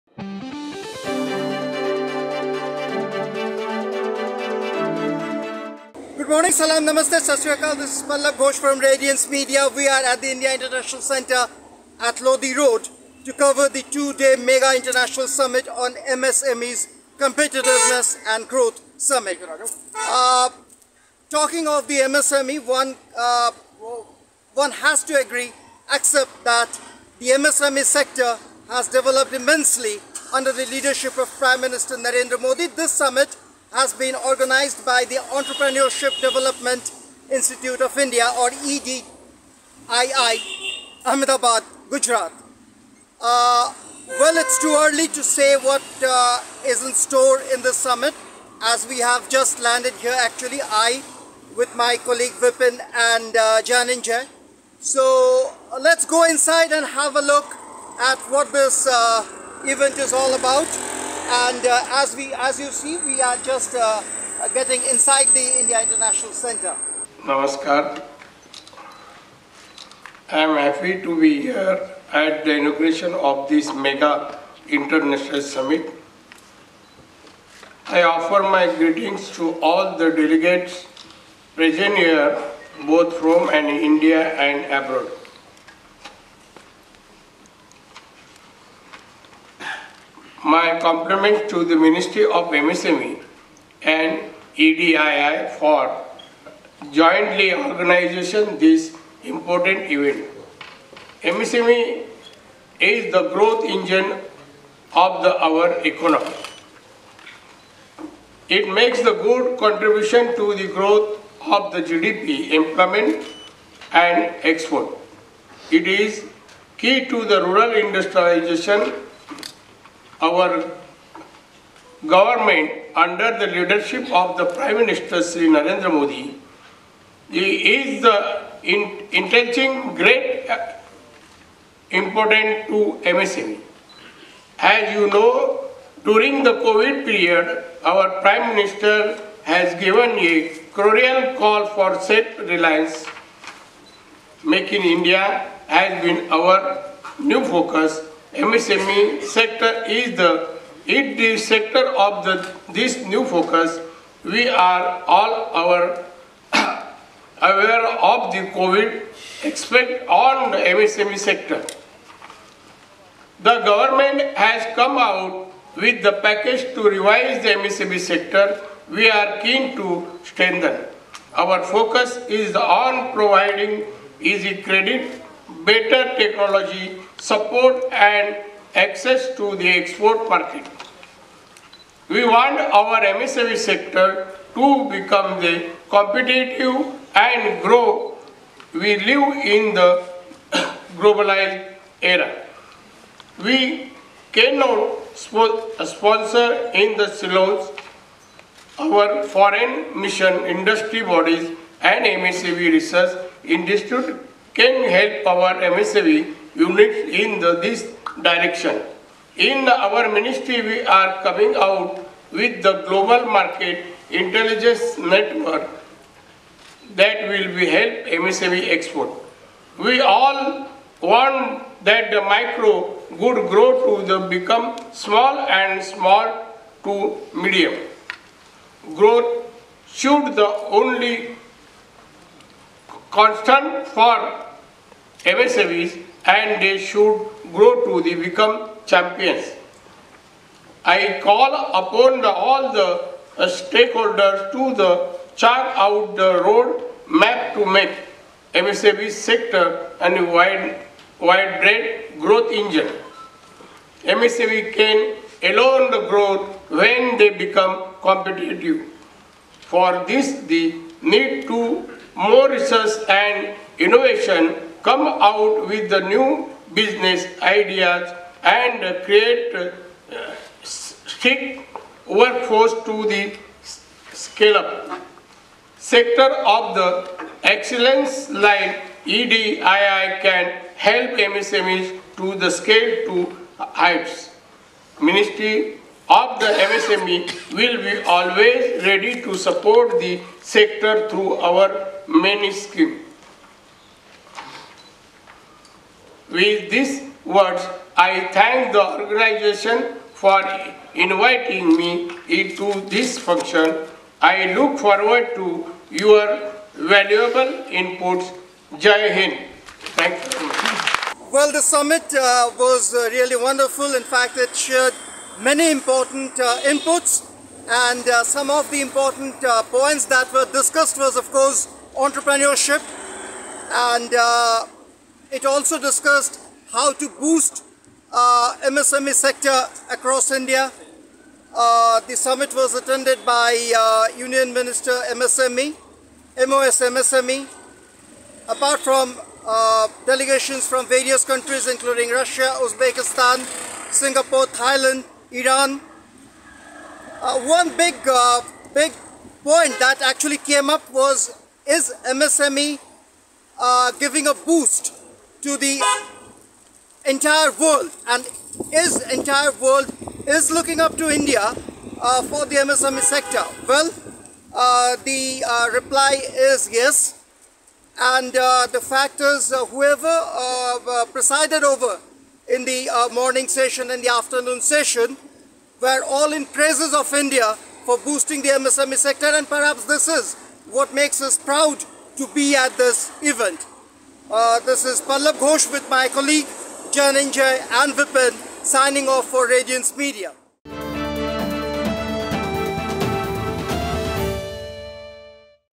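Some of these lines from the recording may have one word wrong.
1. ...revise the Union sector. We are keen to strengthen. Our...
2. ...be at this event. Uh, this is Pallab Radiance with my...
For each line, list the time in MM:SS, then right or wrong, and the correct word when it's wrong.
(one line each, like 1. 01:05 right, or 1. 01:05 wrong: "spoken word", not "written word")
1. 02:46 wrong: "MSME", not "Union"
2. 06:22 wrong: "Ghosh", not "Radiance".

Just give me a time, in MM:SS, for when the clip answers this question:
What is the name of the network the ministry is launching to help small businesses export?
03:32.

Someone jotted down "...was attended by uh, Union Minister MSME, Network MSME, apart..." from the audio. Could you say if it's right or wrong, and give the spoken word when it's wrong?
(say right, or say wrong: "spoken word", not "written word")
wrong: "MOS", not "Network".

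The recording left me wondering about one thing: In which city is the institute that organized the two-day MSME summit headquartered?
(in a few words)
Ahmedabad.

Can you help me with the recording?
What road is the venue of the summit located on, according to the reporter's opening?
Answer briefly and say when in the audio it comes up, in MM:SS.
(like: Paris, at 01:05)
Lodi Road, at 00:12.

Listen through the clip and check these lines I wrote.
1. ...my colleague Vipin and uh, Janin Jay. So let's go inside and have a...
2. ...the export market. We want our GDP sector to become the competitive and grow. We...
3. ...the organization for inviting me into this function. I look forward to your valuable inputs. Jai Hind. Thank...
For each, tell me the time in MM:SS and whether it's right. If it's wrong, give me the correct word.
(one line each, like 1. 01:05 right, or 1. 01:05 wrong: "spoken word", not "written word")
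1. 00:51 right
2. 02:59 wrong: "MSME", not "GDP"
3. 04:58 right.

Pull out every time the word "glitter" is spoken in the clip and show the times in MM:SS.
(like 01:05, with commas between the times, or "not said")
not said.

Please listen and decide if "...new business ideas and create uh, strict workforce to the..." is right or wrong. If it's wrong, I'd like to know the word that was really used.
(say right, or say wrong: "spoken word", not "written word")
right.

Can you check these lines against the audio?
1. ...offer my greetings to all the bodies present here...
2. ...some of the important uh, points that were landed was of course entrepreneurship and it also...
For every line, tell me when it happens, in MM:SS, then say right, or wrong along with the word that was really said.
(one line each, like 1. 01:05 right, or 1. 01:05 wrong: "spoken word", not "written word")
1. 01:18 wrong: "delegates", not "bodies"
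2. 05:18 wrong: "discussed", not "landed".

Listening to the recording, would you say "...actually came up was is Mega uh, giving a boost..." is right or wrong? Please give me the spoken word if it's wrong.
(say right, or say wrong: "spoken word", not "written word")
wrong: "MSME", not "Mega".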